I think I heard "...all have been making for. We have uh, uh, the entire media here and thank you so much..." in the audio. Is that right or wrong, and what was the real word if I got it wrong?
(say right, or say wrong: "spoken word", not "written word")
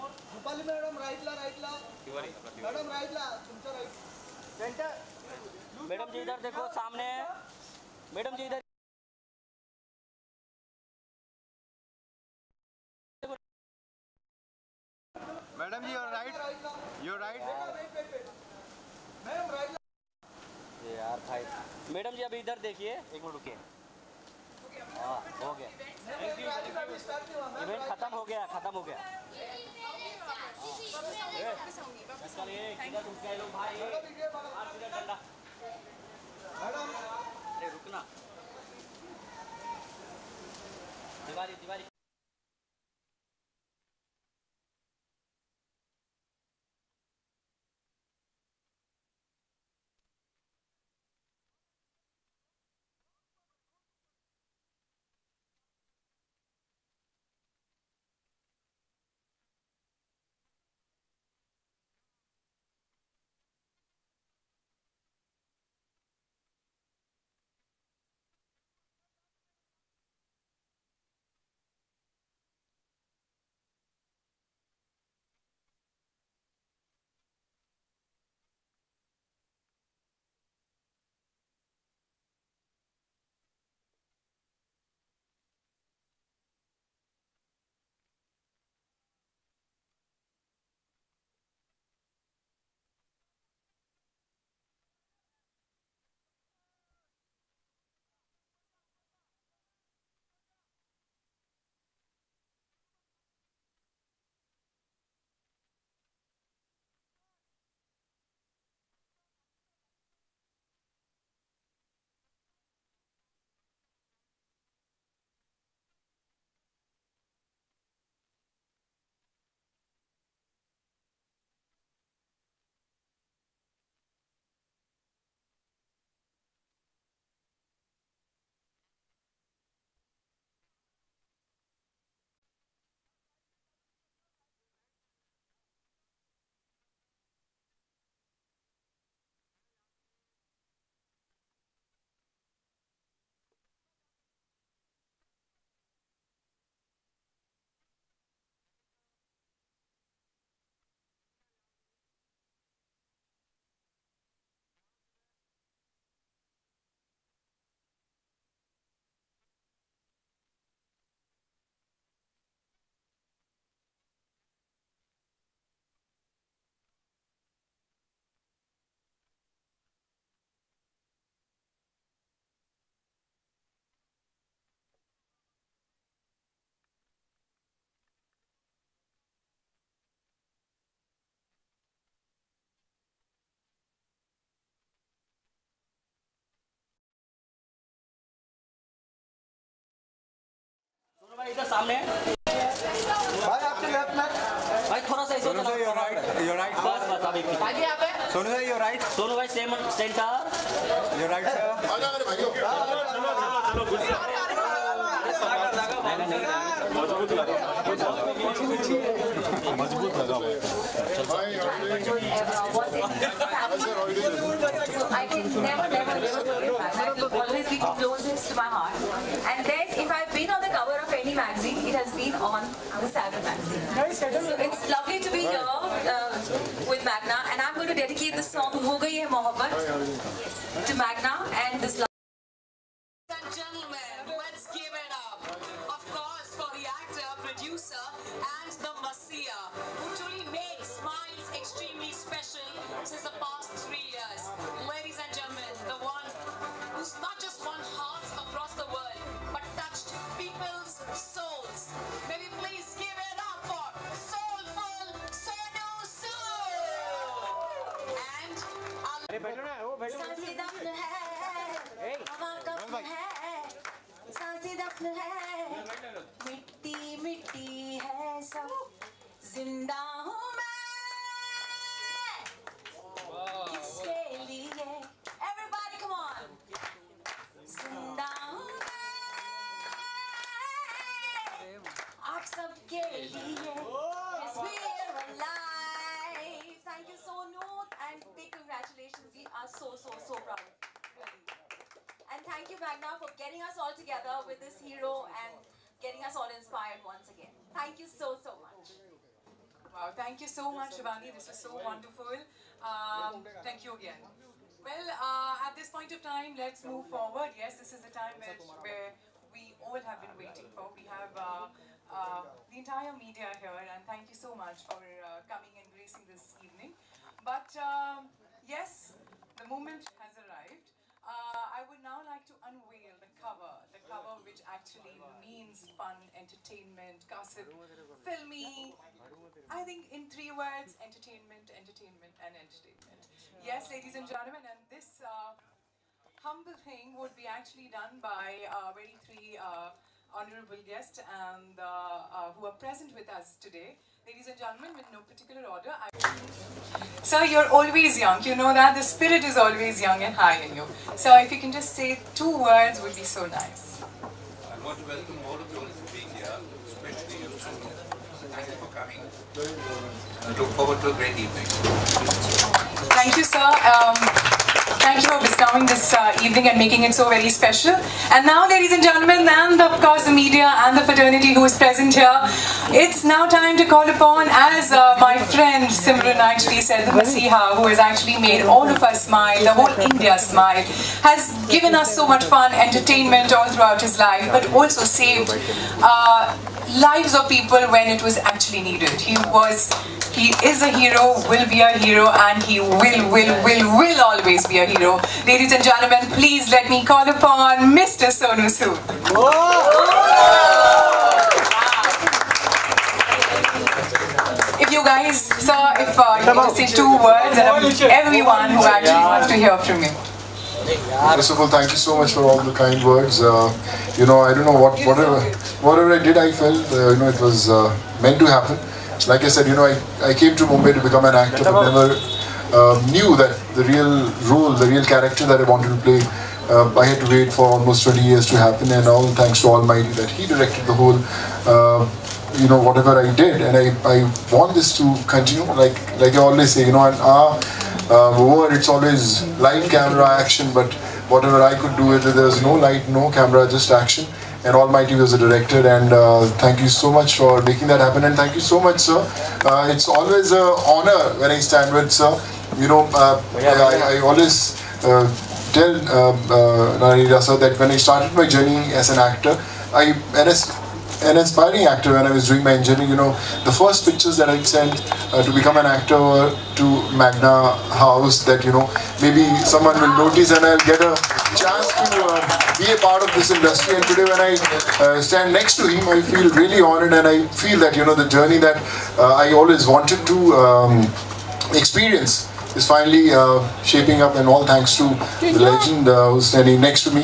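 wrong: "waiting", not "making".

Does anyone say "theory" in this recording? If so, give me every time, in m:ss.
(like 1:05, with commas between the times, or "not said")
not said.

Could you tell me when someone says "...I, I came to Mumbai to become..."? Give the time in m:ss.
6:59.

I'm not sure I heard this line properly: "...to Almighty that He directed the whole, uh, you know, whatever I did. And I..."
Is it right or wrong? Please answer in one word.
right.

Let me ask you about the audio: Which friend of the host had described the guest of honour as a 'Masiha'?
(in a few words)
Simran.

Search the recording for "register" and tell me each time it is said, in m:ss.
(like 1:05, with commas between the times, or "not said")
not said.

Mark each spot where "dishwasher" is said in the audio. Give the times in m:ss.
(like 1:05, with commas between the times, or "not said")
not said.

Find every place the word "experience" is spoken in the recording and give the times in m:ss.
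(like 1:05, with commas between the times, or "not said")
8:01.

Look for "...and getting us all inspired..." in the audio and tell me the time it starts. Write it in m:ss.
4:55.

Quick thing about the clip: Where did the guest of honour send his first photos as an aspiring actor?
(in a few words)
Magna House.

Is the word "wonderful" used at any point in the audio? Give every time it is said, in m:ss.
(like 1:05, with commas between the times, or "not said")
5:01.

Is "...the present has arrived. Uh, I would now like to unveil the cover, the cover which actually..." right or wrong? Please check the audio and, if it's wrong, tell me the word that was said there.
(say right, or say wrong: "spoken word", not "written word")
wrong: "moment", not "present".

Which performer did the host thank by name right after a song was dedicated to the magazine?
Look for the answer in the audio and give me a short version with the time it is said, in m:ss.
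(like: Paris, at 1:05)
Shivani, at 5:00.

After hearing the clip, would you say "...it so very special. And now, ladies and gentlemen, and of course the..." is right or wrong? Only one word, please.
right.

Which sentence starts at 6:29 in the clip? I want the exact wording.
He was he is a hero, will be a hero, and he will, will, will, will always be a hero.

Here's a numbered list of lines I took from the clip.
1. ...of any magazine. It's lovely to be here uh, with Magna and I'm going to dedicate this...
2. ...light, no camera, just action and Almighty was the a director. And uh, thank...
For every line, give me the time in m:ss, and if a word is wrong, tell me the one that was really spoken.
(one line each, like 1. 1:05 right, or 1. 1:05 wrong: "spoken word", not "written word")
1. 3:41 right
2. 7:22 right.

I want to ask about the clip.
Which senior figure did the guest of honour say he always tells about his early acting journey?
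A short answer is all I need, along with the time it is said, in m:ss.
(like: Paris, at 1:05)
Nari Hira, at 7:36.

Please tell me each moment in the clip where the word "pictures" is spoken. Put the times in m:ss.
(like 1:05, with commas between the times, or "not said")
7:44.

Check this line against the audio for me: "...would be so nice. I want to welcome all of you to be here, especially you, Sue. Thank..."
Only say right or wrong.
right.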